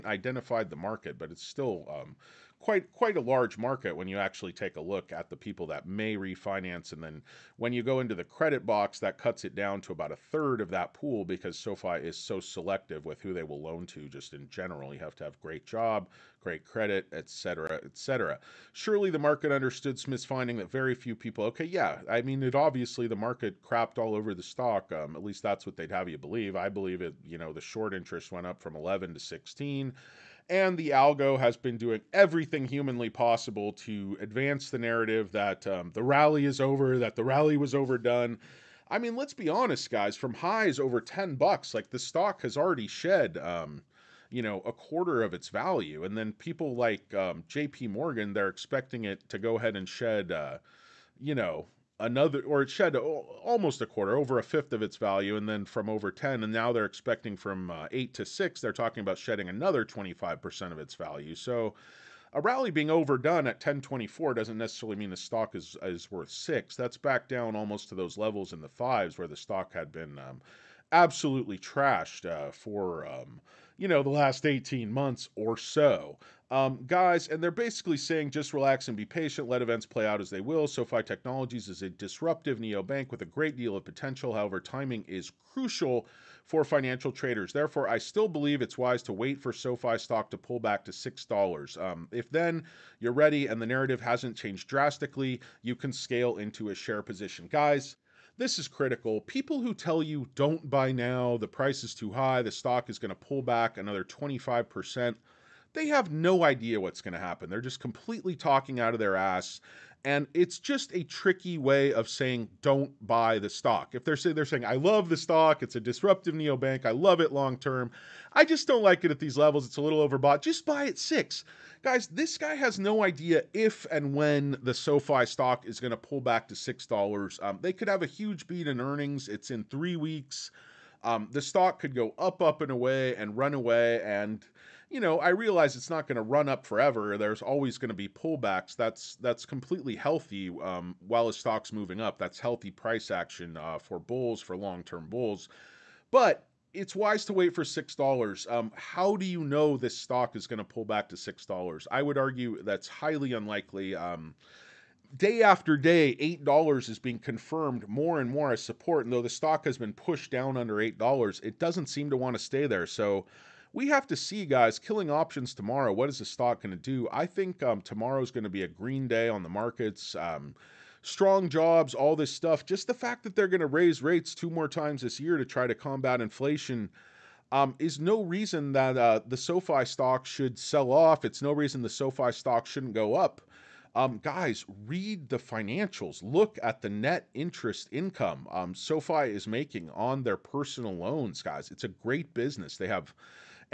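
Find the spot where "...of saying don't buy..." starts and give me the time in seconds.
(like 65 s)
111 s.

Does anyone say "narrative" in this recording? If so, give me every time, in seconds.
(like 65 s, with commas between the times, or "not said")
34 s, 93 s.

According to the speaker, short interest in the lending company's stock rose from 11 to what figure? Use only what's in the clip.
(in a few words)
16.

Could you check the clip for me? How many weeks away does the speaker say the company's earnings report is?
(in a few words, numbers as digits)
3.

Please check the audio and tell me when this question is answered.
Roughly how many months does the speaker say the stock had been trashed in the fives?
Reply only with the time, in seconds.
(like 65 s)
74 s.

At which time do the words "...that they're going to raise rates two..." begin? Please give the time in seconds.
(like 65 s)
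173 s.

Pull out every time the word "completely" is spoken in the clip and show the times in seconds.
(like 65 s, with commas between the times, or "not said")
107 s, 139 s.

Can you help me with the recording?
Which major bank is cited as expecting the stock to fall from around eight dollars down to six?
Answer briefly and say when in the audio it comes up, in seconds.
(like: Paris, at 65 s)
J.P. Morgan, at 47 s.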